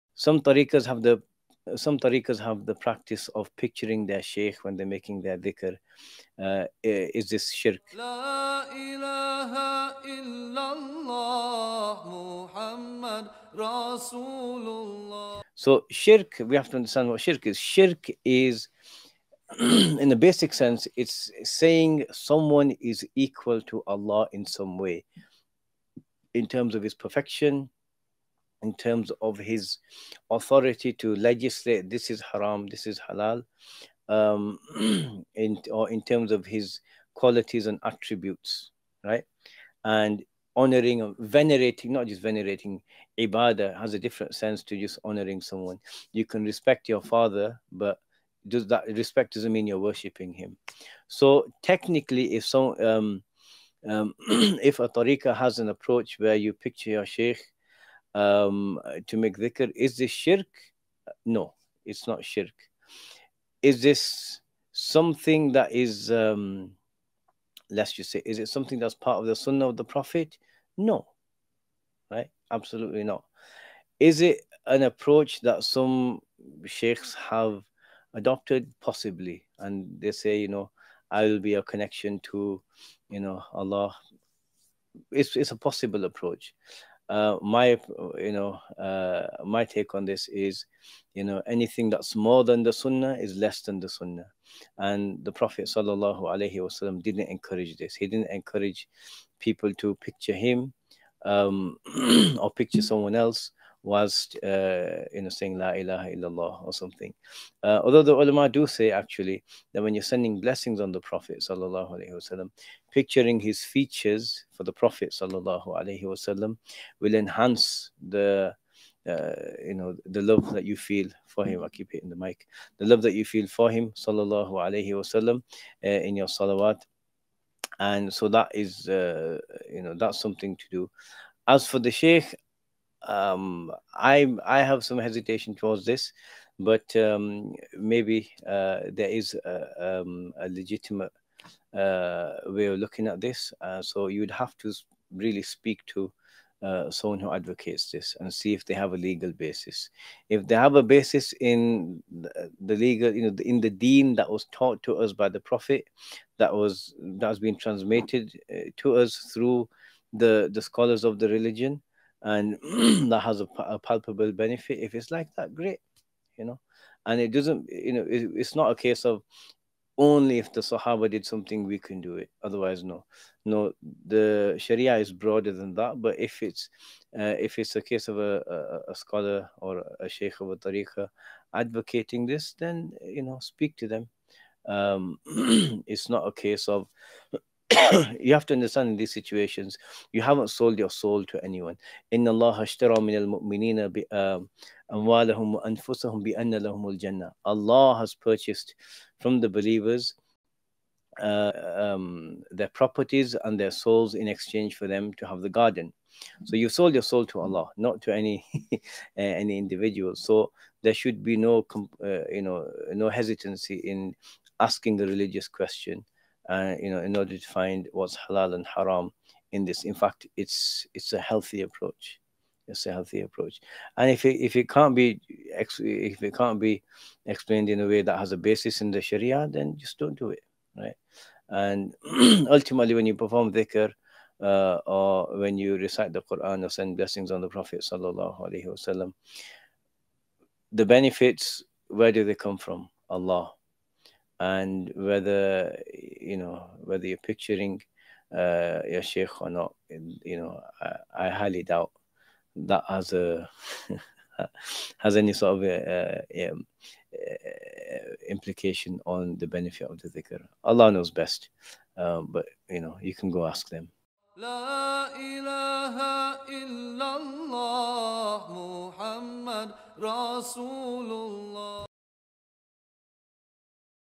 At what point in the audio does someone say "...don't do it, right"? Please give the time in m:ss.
3:49.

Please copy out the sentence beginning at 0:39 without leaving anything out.
And honoring, venerating, not just venerating, ibadah has a different sense to just honoring someone.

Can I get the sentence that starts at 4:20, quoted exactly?
Allah knows best, um, but you know, you can go ask them.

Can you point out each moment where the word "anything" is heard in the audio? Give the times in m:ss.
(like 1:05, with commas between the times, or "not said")
1:31.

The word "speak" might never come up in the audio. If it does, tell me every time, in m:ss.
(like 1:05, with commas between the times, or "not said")
2:25, 3:03.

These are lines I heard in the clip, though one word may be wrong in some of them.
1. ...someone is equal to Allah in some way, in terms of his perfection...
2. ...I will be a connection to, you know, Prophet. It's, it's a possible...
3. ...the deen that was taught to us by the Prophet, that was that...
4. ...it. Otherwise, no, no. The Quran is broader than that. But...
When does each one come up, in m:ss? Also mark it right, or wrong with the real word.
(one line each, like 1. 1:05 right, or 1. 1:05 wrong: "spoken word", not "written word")
1. 0:22 right
2. 1:21 wrong: "Allah", not "Prophet"
3. 2:33 right
4. 2:52 wrong: "Sharia", not "Quran".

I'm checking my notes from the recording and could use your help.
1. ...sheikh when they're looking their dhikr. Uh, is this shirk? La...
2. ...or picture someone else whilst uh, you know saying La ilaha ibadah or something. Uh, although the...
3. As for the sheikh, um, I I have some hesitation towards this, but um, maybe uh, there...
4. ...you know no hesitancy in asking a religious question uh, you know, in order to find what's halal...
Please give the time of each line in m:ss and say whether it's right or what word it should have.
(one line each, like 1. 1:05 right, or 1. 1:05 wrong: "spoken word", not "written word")
1. 0:04 wrong: "making", not "looking"
2. 1:42 wrong: "illallah", not "ibadah"
3. 2:11 right
4. 3:32 right.